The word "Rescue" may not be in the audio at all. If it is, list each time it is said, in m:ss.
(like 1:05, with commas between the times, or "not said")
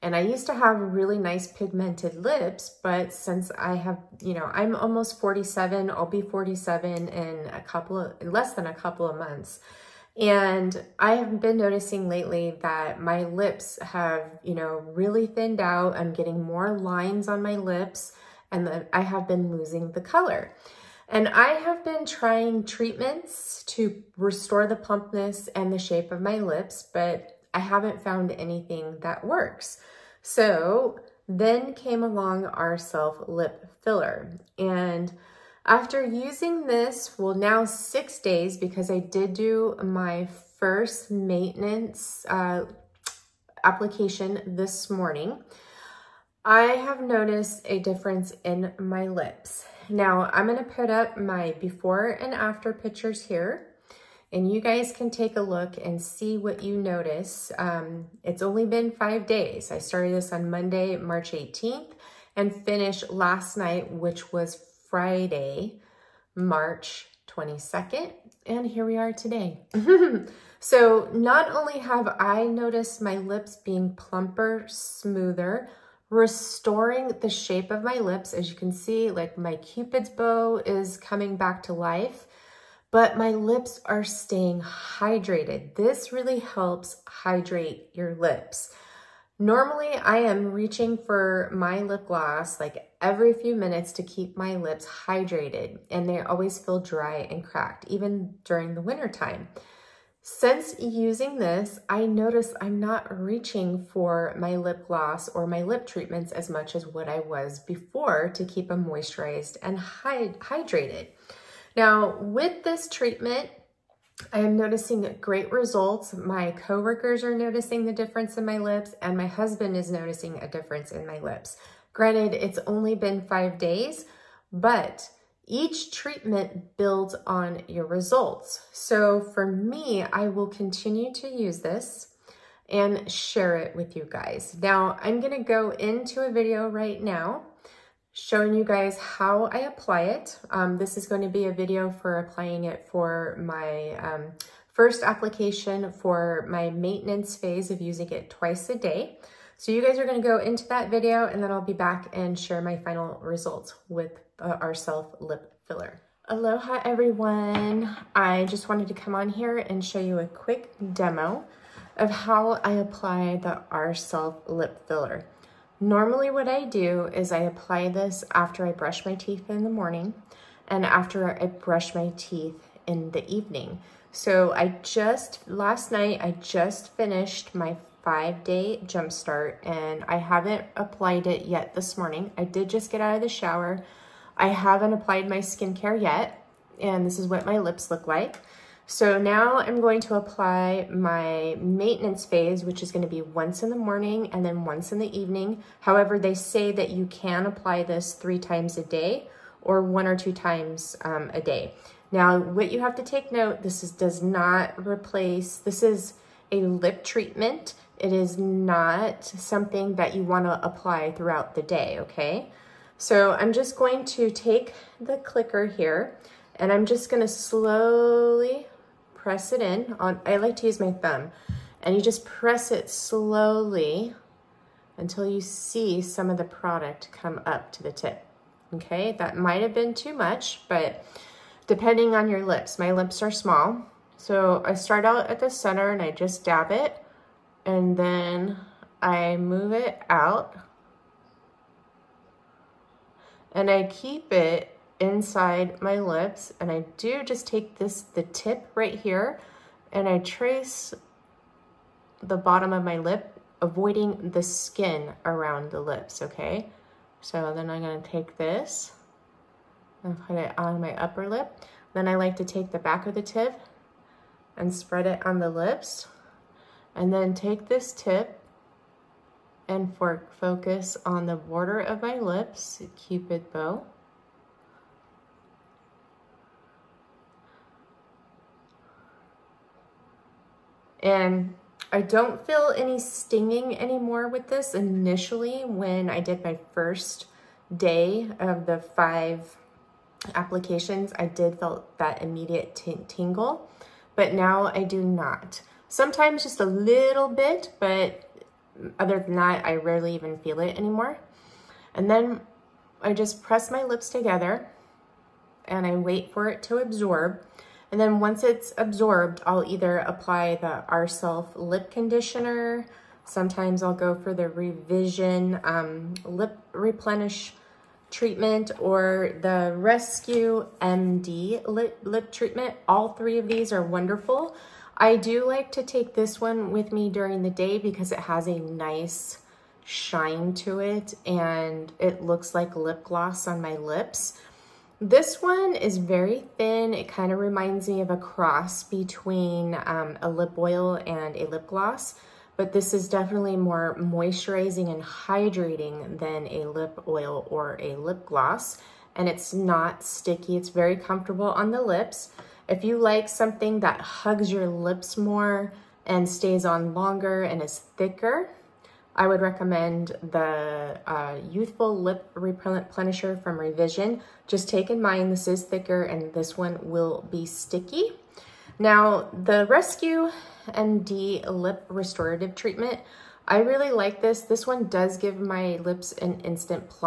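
5:19, 6:09.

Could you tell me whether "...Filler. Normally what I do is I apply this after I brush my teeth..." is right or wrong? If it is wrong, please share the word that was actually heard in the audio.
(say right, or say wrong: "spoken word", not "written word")
right.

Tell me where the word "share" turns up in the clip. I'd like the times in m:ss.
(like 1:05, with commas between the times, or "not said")
2:13, 2:32.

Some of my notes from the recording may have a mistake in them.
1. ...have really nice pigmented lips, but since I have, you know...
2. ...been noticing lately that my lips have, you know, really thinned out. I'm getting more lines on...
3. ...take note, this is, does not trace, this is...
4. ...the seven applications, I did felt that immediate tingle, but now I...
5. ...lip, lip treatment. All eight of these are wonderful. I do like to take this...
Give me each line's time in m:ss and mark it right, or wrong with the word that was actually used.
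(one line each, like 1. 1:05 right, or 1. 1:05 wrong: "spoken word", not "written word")
1. 0:00 right
2. 0:11 right
3. 3:23 wrong: "replace", not "trace"
4. 4:48 wrong: "five", not "seven"
5. 5:21 wrong: "three", not "eight".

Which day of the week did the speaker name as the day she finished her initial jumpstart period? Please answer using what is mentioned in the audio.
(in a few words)
Friday.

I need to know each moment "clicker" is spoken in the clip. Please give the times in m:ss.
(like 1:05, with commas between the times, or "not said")
3:35.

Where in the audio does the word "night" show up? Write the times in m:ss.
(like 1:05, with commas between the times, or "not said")
1:03, 2:55.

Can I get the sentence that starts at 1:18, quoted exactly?
As you can see, like my cupid's bow is coming back to life but my lips are staying hydrated.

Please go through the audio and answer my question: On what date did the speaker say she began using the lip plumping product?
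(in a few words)
March 18th.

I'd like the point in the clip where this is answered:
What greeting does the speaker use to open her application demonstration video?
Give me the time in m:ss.
2:36.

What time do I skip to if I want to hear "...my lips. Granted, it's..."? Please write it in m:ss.
2:01.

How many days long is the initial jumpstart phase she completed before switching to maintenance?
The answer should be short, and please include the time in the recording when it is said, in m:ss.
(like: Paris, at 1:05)
5, at 2:58.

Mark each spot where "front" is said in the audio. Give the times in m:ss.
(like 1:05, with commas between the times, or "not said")
not said.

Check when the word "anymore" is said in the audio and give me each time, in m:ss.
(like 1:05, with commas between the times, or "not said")
4:43, 5:00.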